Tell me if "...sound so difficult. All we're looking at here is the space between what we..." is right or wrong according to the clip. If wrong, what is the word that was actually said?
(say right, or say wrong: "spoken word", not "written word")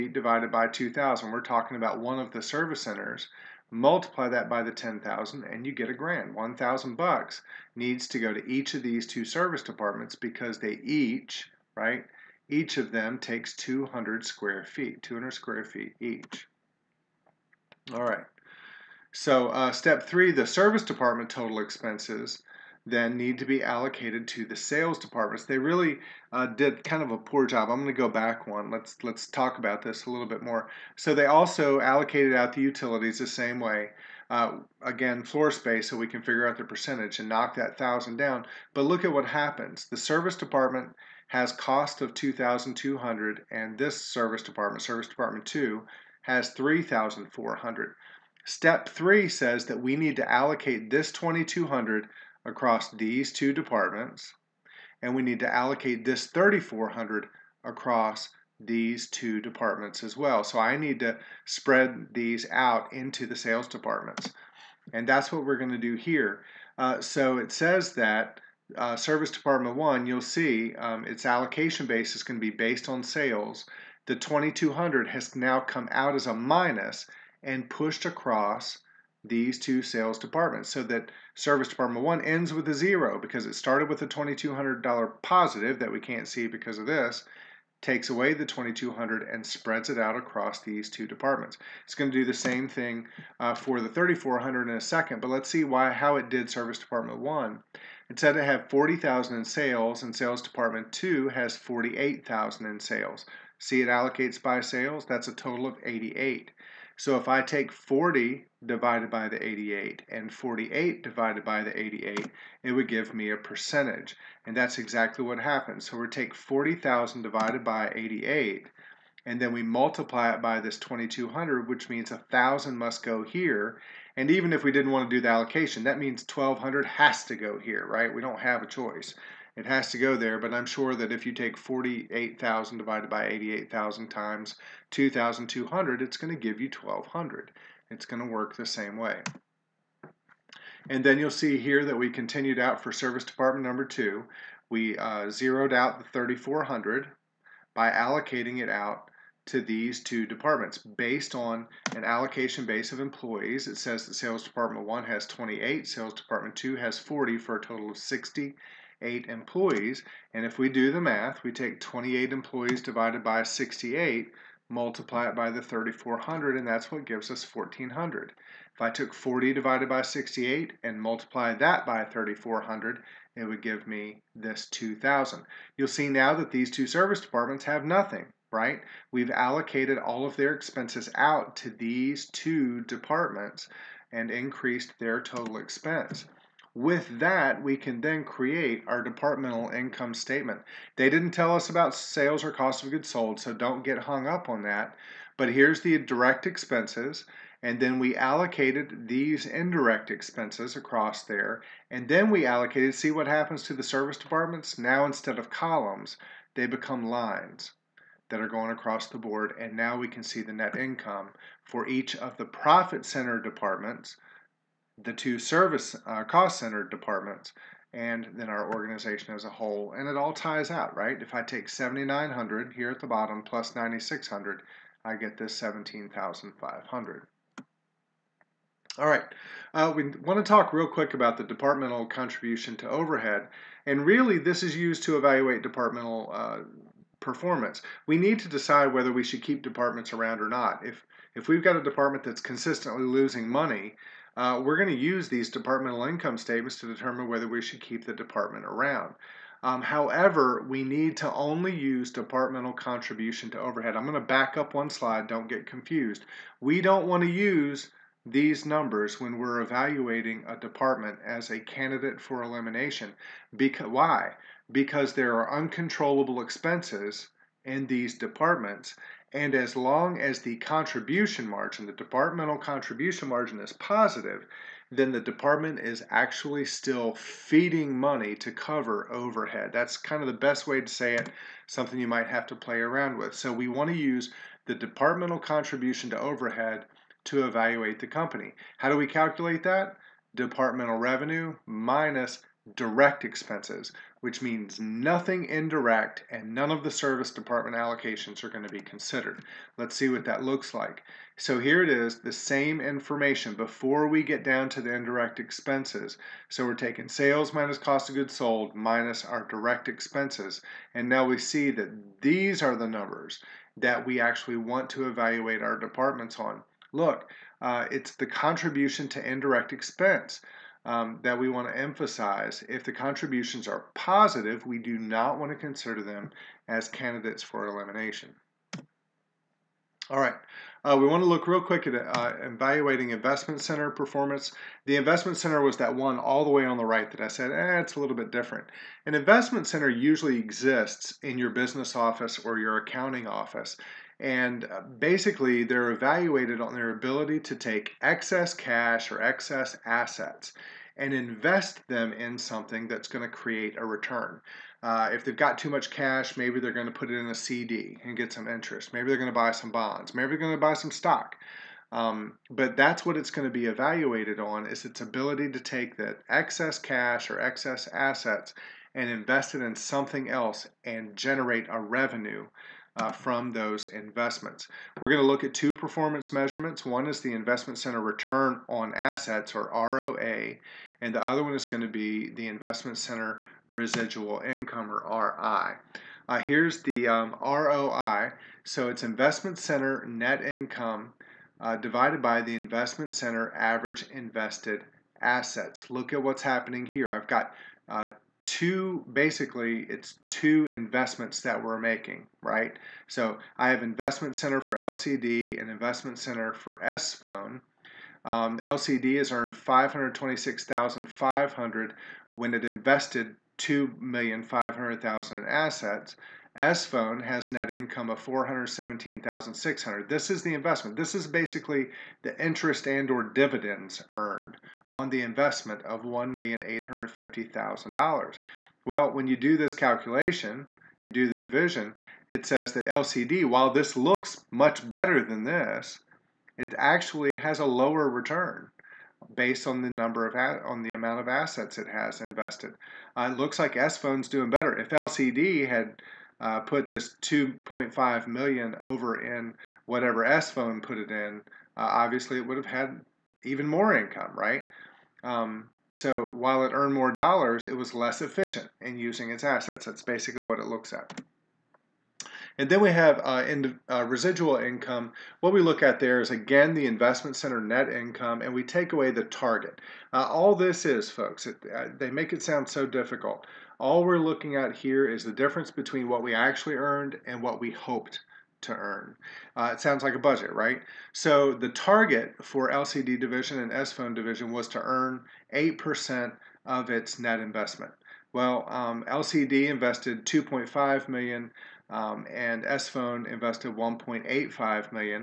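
wrong: "difference", not "space".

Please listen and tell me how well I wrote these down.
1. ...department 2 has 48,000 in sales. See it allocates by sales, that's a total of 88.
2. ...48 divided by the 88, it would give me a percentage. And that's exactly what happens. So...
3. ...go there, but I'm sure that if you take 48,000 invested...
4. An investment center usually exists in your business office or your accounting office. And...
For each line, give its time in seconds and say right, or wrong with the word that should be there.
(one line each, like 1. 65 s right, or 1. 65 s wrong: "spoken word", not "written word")
1. 100 s right
2. 110 s right
3. 129 s wrong: "divided", not "invested"
4. 339 s right.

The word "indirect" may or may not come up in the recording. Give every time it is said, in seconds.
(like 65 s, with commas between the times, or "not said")
199 s, 295 s, 304 s, 319 s.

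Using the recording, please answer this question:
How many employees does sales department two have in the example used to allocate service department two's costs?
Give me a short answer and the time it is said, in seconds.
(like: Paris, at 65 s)
40, at 155 s.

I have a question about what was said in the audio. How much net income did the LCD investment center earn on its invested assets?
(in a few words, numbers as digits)
526,500.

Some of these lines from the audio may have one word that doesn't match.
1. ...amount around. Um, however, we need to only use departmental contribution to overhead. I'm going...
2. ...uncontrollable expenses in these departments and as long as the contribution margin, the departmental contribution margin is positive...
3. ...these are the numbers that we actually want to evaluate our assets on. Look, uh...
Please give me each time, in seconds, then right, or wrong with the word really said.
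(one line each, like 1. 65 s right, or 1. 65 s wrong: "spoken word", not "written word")
1. 248 s wrong: "department", not "amount"
2. 265 s right
3. 312 s wrong: "departments", not "assets".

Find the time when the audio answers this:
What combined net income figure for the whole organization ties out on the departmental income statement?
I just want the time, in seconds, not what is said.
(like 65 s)
225 s.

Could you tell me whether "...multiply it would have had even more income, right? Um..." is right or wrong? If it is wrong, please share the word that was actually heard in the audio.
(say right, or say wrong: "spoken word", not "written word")
wrong: "obviously", not "multiply".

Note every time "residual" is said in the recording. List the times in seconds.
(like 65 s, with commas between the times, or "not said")
383 s, 464 s.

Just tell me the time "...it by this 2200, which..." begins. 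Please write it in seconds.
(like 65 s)
120 s.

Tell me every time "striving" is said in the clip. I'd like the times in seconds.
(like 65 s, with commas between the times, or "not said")
not said.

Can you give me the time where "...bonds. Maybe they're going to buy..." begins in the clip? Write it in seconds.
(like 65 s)
359 s.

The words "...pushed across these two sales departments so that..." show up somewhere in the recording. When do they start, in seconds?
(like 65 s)
77 s.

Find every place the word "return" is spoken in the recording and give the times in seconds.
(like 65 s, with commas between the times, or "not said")
353 s, 378 s, 438 s.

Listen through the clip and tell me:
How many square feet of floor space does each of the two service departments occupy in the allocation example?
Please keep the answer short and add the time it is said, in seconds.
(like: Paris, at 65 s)
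200, at 15 s.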